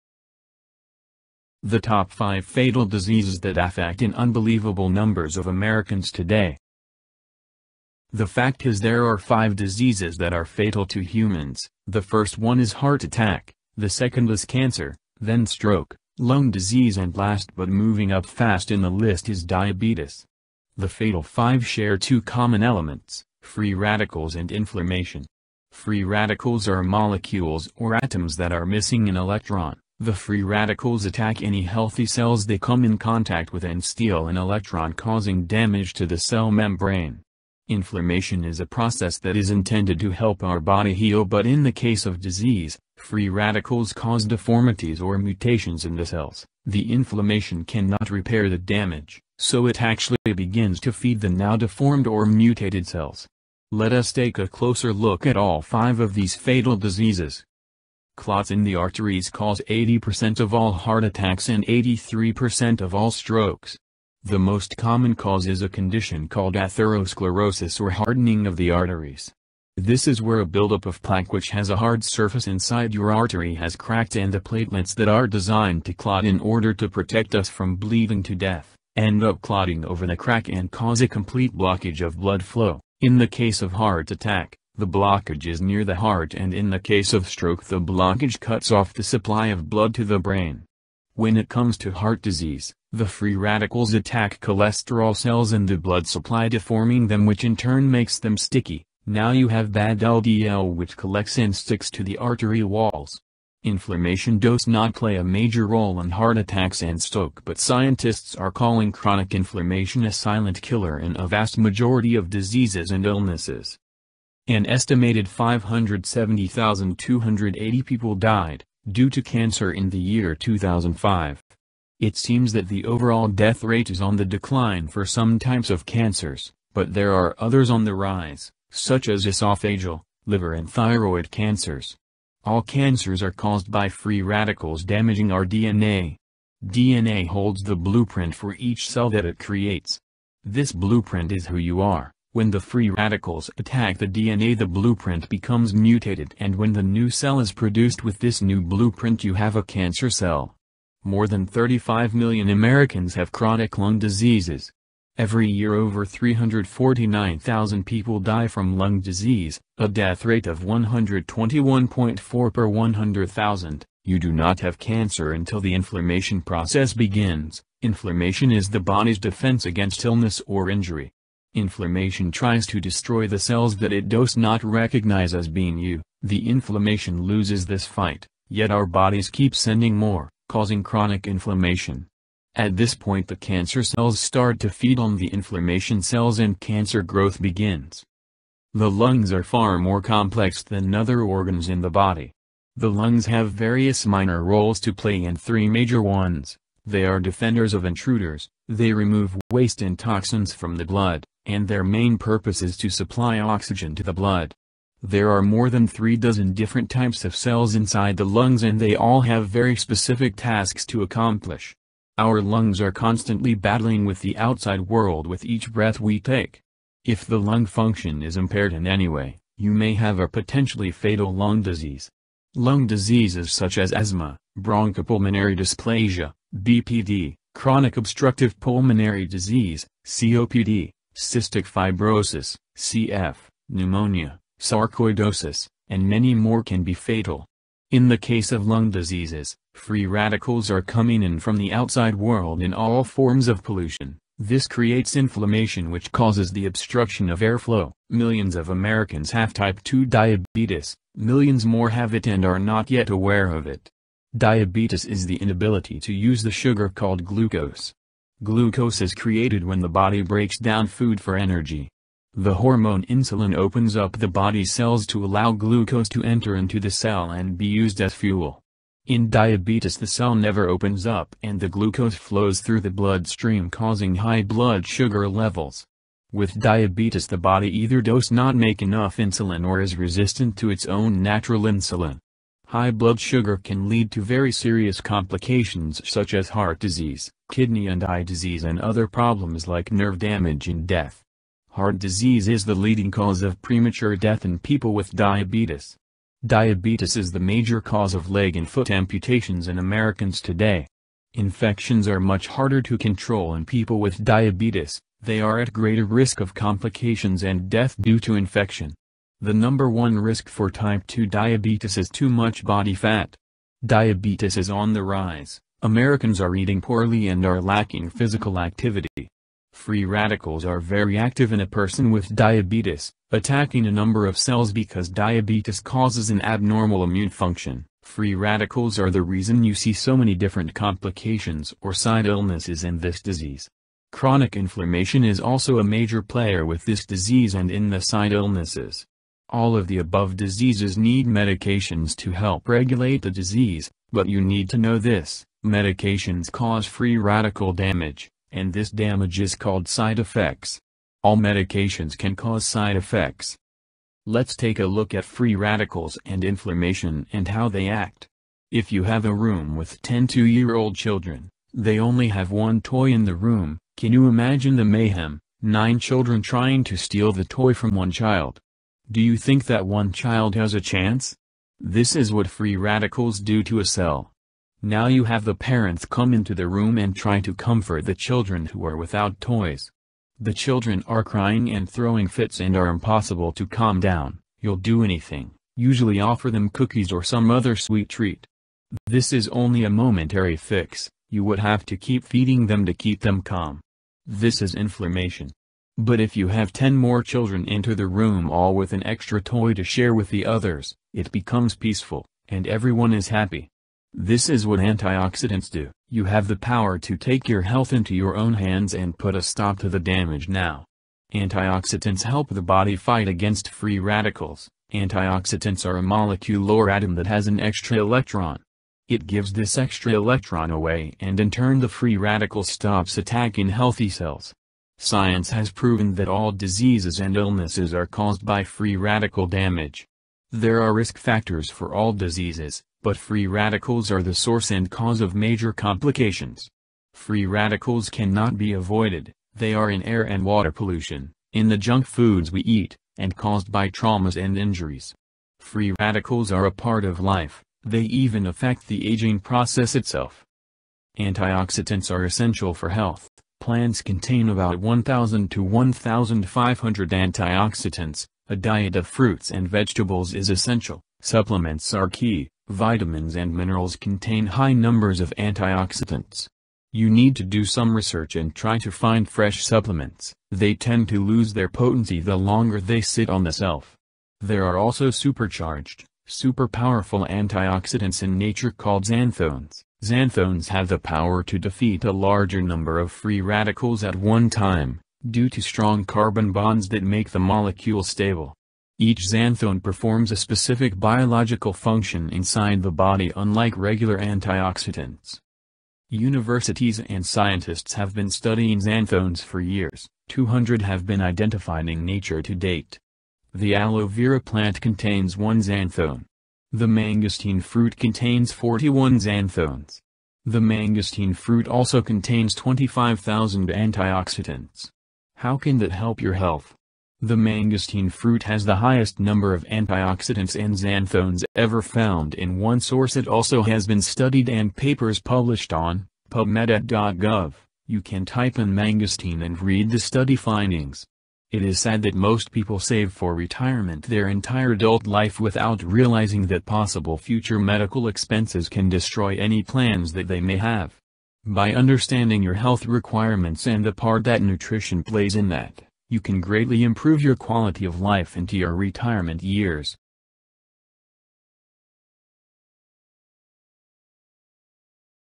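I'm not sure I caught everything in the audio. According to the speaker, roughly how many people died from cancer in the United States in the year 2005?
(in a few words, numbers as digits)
570,280.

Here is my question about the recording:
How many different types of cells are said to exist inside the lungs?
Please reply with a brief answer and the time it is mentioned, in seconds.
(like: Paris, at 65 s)
More than three dozen, at 205 s.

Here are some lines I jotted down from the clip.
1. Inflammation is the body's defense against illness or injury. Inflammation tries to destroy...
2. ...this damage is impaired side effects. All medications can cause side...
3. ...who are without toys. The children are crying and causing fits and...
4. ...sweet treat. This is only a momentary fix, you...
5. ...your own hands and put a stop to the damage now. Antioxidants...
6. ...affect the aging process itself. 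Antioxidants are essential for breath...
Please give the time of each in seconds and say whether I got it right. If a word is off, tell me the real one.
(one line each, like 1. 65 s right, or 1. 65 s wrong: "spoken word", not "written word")
1. 167 s right
2. 348 s wrong: "called", not "impaired"
3. 378 s wrong: "throwing", not "causing"
4. 387 s right
5. 408 s right
6. 448 s wrong: "health", not "breath".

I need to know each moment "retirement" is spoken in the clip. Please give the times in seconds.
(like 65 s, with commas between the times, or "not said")
533 s, 548 s.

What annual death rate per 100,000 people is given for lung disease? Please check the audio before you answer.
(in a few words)
121.4.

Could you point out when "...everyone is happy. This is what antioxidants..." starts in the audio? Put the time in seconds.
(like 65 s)
402 s.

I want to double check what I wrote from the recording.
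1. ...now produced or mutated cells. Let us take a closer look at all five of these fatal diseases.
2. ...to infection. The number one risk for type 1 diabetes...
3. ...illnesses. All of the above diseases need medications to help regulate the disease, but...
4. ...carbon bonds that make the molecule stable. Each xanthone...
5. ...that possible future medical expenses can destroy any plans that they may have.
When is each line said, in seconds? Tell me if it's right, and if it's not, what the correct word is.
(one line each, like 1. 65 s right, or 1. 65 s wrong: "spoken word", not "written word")
1. 51 s wrong: "deformed", not "produced"
2. 308 s wrong: "2", not "1"
3. 338 s right
4. 486 s right
5. 536 s right.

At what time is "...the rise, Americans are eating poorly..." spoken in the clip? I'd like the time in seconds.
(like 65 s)
314 s.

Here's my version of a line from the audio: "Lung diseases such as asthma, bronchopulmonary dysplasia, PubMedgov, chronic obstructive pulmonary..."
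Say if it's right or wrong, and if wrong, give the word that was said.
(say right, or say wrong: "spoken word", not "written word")
wrong: "BPD", not "PubMedgov".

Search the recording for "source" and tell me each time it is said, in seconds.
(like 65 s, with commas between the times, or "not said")
434 s, 522 s.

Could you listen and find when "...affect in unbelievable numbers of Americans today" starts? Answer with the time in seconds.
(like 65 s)
3 s.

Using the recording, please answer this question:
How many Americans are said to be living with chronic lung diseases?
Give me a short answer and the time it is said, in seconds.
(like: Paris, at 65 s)
More than 35 million, at 151 s.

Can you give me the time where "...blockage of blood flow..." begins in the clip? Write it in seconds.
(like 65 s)
81 s.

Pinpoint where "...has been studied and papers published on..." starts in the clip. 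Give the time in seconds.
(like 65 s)
523 s.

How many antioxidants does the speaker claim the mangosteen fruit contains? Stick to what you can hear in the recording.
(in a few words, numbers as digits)
25,000.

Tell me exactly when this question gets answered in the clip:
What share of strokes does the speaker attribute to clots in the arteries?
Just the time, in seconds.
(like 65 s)
61 s.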